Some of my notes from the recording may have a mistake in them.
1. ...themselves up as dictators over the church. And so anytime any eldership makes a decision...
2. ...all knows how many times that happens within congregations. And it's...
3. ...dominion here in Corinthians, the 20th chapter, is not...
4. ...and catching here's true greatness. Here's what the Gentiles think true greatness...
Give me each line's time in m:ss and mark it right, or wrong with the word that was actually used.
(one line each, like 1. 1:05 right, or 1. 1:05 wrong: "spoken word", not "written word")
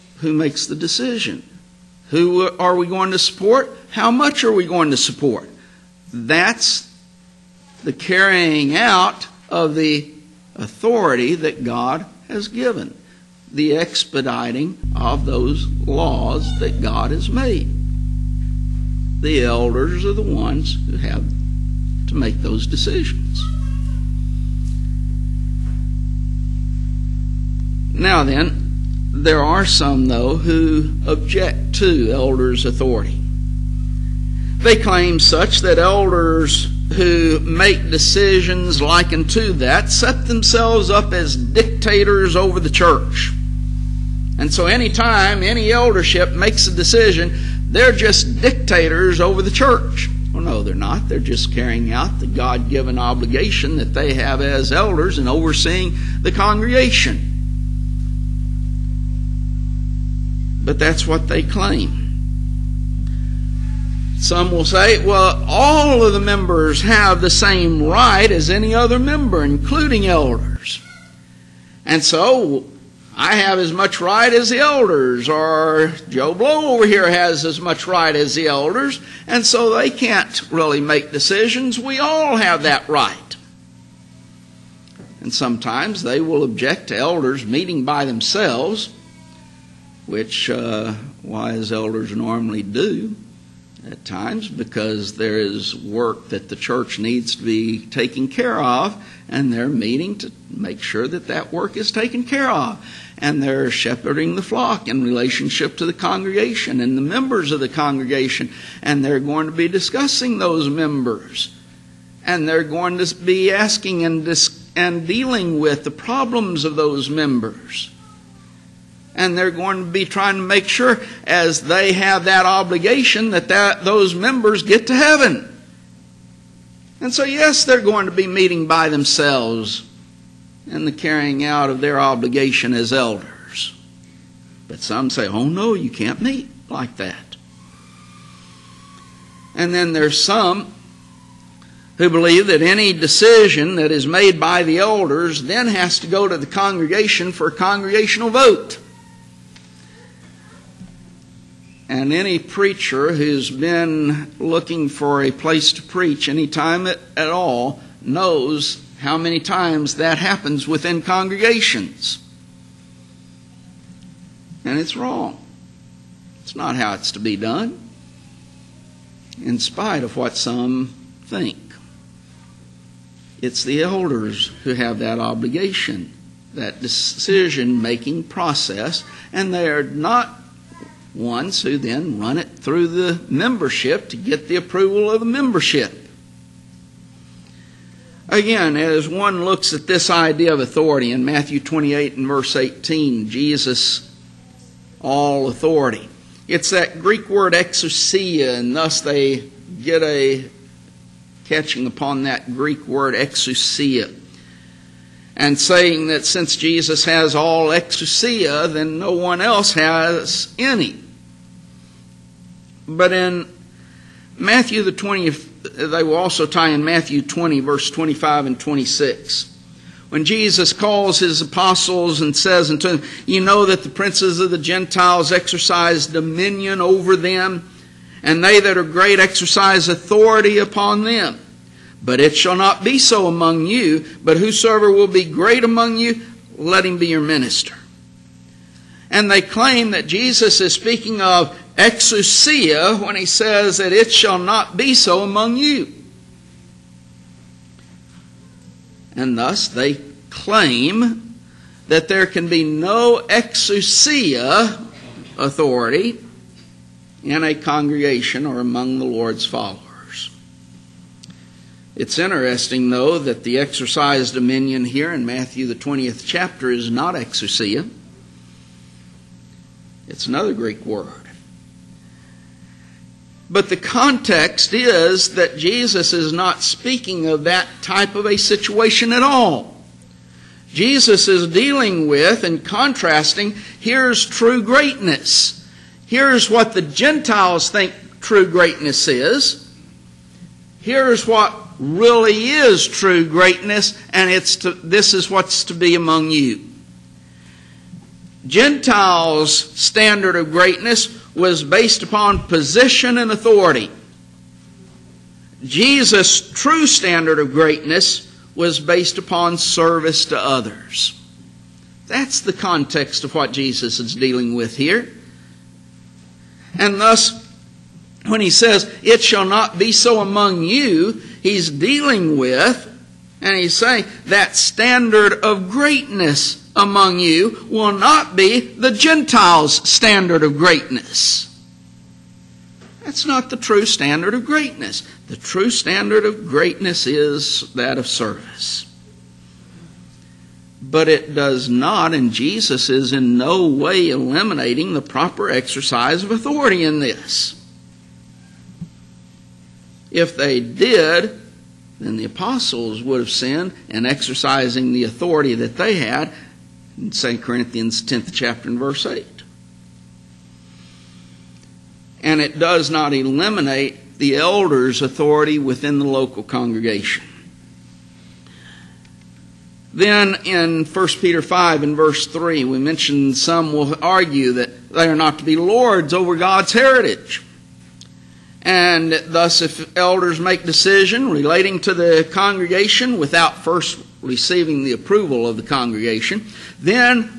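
1. 0:40 right
2. 2:37 right
3. 4:24 wrong: "Matthew", not "Corinthians"
4. 4:42 wrong: "contrasting", not "catching".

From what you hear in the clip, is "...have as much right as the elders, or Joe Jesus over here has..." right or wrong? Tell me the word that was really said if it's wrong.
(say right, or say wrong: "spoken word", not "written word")
wrong: "Blow", not "Jesus".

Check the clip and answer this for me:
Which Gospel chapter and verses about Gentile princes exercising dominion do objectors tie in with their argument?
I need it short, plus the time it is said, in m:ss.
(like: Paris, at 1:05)
Matthew 20:25-26, at 3:36.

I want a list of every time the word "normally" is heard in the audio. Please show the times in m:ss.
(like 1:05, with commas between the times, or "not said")
1:32.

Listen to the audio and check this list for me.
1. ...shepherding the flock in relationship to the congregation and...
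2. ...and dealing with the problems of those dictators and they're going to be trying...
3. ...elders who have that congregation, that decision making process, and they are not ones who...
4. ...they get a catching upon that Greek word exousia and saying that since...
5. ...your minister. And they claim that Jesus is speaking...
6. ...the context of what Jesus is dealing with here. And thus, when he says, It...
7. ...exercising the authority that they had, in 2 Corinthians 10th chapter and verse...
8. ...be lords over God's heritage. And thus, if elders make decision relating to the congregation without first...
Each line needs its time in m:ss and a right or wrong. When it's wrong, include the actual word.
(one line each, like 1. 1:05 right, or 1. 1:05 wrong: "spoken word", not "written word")
1. 1:43 right
2. 1:54 wrong: "members", not "dictators"
3. 2:53 wrong: "obligation", not "congregation"
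4. 3:19 right
5. 3:57 right
6. 5:12 right
7. 5:54 right
8. 6:15 right.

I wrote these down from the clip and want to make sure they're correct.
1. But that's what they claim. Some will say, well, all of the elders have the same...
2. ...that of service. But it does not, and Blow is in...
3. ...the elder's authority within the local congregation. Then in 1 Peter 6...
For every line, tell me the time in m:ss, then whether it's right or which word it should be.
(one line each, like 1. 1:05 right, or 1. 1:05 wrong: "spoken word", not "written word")
1. 1:00 wrong: "members", not "elders"
2. 5:37 wrong: "Jesus", not "Blow"
3. 6:04 wrong: "5", not "6".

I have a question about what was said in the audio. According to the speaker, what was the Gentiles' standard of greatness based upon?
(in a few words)
position and authority.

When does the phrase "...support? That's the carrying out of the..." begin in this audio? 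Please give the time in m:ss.
0:04.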